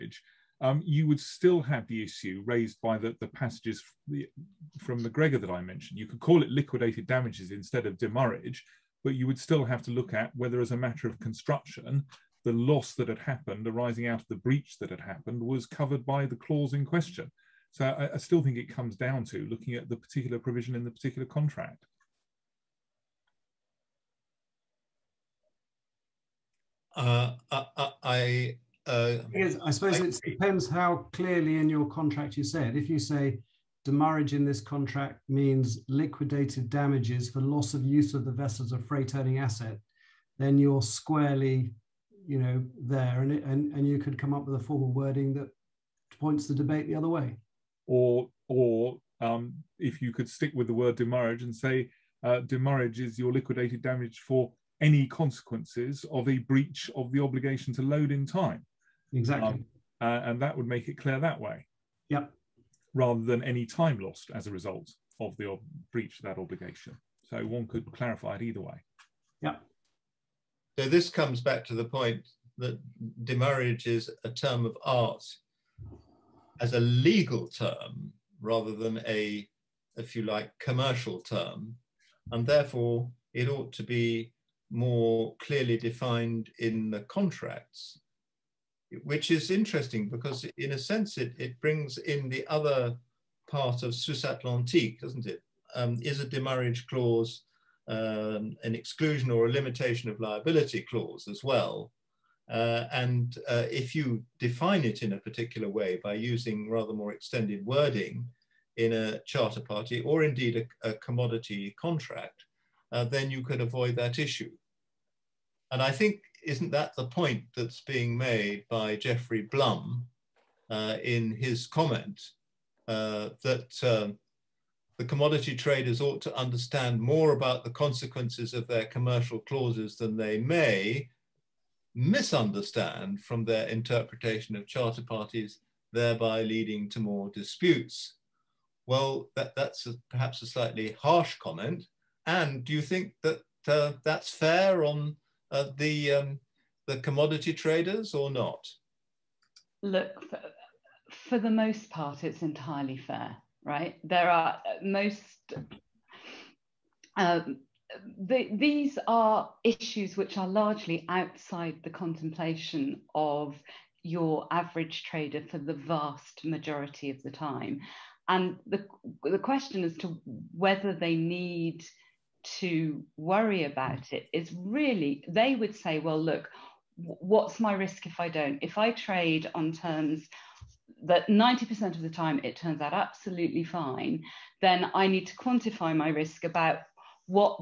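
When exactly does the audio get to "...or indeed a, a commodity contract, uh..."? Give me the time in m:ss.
1:50.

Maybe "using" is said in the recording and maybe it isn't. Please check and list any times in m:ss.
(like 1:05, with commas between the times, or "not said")
1:46.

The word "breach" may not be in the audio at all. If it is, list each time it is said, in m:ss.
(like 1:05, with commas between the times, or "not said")
0:14, 0:56, 1:05.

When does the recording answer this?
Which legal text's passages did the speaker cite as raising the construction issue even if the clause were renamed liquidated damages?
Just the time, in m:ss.
0:05.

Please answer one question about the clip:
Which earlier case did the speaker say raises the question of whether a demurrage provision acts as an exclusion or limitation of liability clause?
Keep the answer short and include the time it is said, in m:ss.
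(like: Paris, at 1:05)
Suisse Atlantique, at 1:33.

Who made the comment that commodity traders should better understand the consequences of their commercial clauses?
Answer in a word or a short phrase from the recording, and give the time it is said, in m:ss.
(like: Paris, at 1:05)
Jeffrey Blum, at 1:58.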